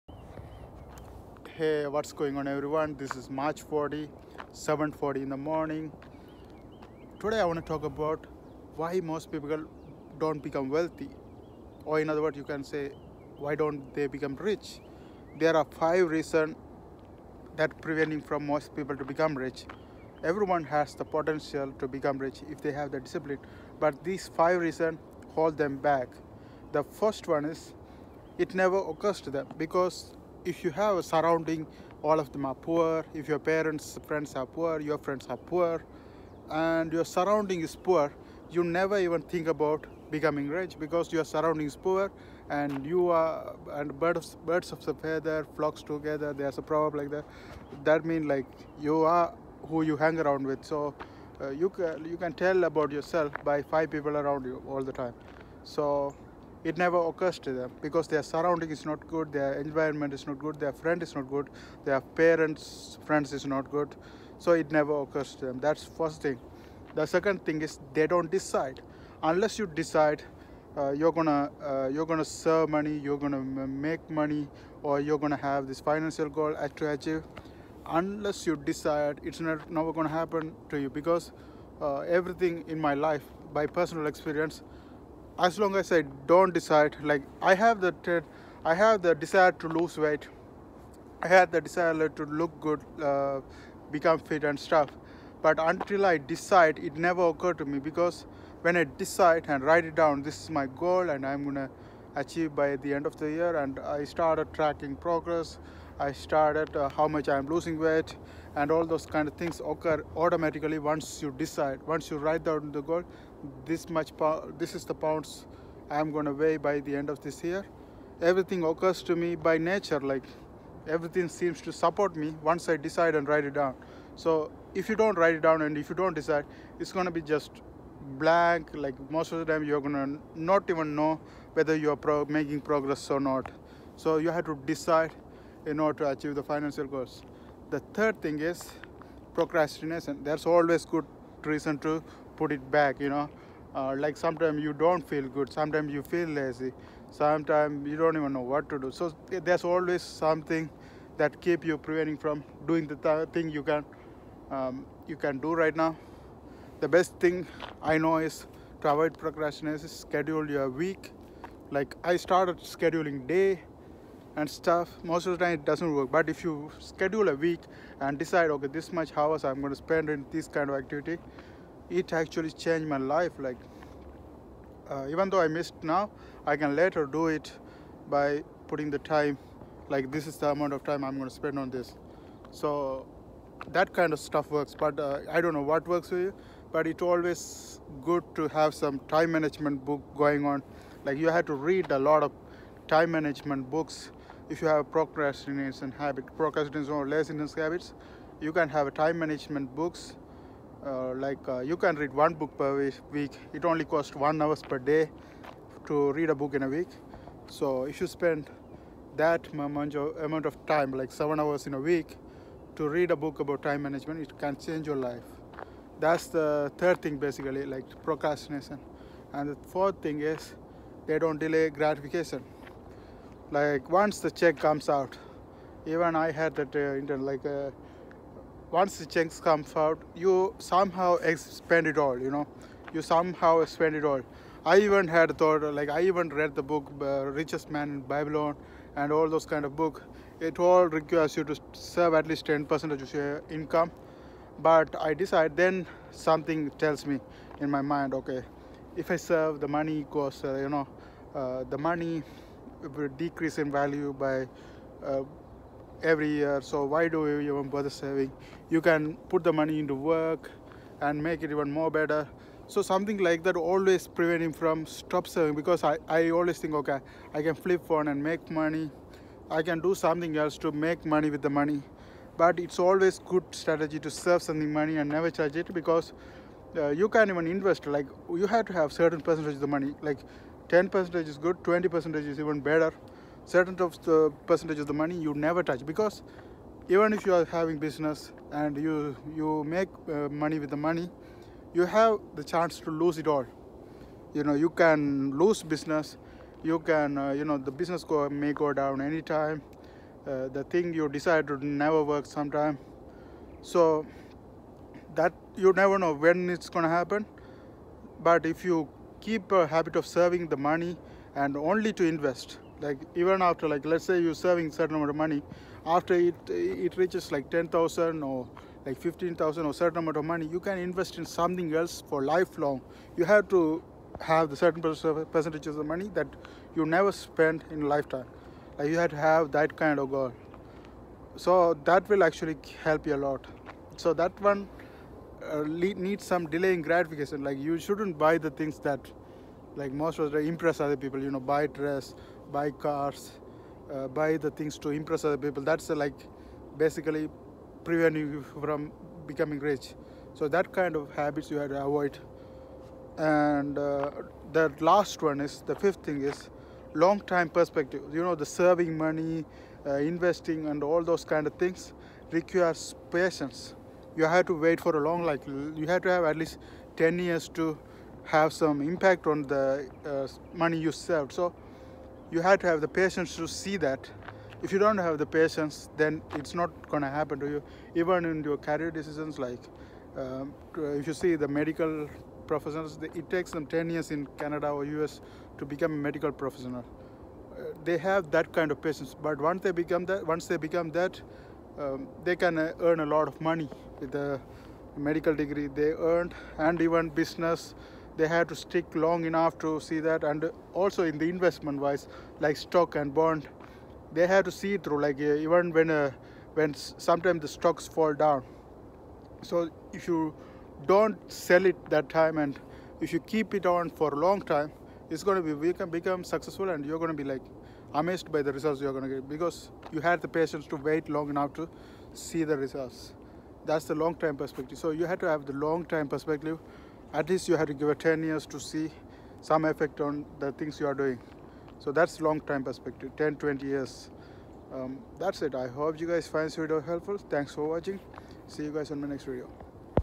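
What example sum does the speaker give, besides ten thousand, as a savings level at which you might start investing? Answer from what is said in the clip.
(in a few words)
15000.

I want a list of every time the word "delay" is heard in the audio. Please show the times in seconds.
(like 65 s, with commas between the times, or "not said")
221 s, 336 s.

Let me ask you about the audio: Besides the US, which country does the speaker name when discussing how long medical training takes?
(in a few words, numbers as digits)
Canada.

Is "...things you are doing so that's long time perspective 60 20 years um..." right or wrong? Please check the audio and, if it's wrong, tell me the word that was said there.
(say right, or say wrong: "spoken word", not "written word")
wrong: "10", not "60".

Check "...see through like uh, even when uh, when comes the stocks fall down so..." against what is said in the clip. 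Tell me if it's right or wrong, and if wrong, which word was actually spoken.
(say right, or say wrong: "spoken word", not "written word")
wrong: "sometimes", not "comes".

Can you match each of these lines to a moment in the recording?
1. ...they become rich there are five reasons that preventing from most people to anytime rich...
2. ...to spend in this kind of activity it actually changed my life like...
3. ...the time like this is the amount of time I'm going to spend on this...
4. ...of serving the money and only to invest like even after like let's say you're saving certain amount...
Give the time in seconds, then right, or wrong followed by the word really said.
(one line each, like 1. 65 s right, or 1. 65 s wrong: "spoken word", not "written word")
1. 13 s wrong: "become", not "anytime"
2. 169 s right
3. 178 s right
4. 309 s right.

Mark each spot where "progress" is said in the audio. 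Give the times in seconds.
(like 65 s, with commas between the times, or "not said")
104 s, 132 s.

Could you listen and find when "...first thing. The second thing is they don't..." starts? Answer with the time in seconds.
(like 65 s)
65 s.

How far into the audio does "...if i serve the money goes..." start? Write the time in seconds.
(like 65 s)
248 s.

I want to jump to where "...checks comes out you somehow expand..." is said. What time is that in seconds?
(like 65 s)
229 s.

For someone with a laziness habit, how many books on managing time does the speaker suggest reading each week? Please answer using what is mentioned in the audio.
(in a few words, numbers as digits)
1.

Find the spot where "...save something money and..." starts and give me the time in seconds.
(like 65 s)
274 s.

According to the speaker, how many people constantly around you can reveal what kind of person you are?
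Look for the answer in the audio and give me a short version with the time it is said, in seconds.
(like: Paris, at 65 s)
5, at 53 s.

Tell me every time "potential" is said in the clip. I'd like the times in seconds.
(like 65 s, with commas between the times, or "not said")
21 s.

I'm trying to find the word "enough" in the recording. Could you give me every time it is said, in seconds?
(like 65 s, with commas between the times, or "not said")
399 s, 421 s.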